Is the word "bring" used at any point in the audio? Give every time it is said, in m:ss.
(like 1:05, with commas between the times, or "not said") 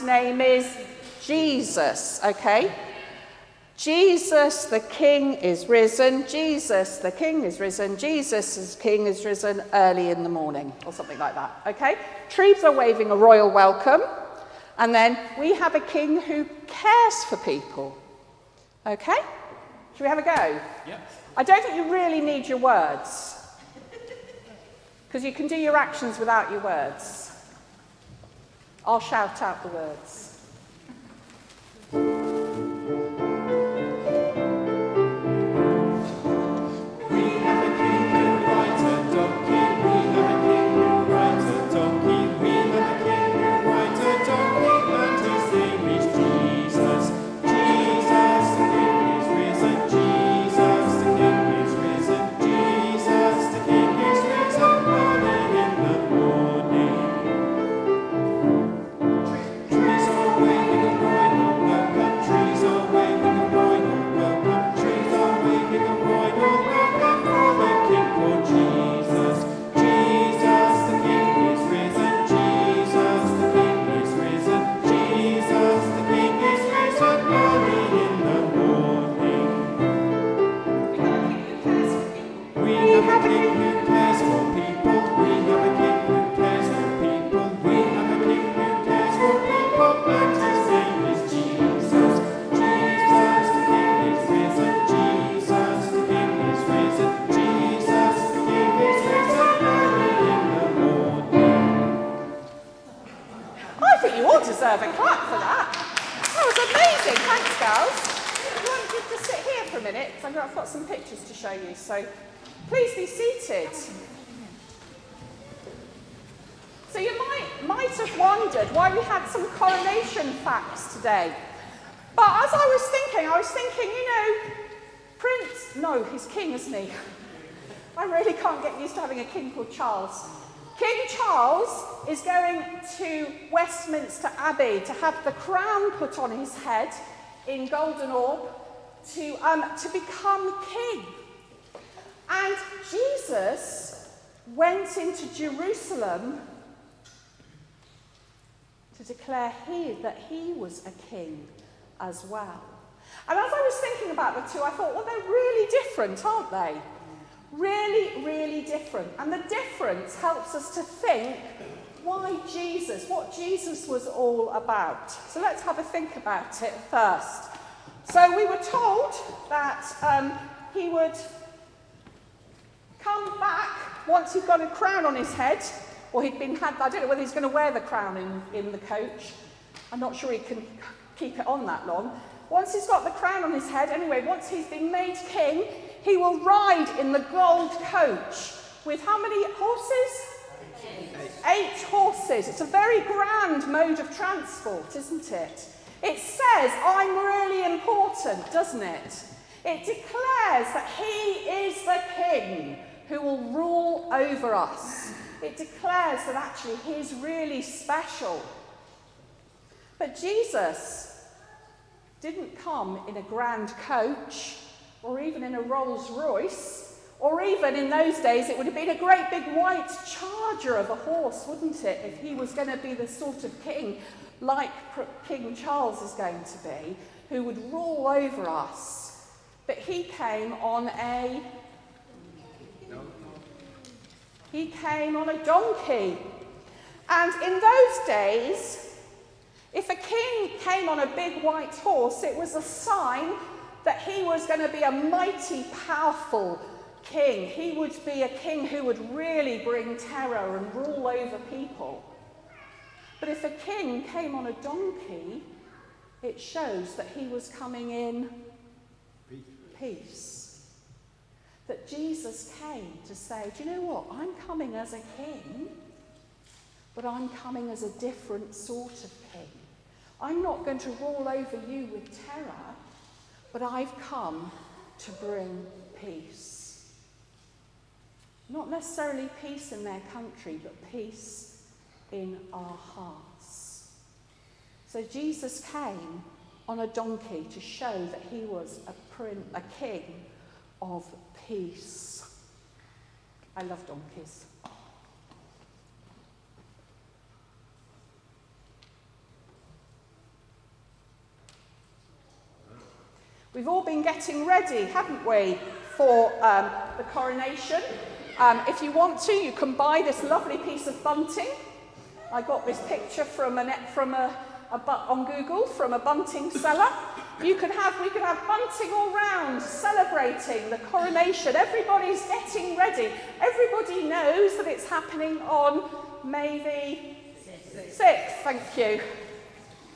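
4:09, 4:35.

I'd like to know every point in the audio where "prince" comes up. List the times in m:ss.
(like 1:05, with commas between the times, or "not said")
4:49.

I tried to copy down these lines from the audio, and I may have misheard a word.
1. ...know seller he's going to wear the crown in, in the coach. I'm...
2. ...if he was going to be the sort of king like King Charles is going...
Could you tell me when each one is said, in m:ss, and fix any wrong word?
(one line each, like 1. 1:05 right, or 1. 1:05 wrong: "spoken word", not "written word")
1. 2:57 wrong: "whether", not "seller"
2. 3:42 right.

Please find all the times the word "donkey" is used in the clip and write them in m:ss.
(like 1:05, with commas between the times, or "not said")
3:55, 4:14, 4:46, 4:53.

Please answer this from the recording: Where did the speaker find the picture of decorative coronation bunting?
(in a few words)
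Google.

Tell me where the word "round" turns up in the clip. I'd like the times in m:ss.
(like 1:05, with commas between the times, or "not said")
5:19.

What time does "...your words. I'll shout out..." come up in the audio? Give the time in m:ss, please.
0:26.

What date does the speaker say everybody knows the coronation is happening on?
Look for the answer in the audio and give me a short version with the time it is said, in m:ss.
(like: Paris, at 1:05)
May 6th, at 5:26.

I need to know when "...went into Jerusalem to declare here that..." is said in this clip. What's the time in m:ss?
2:24.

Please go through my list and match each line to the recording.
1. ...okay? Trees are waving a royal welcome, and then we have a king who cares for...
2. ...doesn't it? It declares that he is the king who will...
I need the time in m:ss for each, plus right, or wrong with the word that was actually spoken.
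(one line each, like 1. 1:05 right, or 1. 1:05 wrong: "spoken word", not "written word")
1. 0:11 right
2. 3:18 right.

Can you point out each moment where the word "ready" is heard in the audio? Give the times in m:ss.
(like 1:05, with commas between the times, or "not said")
5:04, 5:22.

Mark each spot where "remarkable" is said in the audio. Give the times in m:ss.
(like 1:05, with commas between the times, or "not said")
not said.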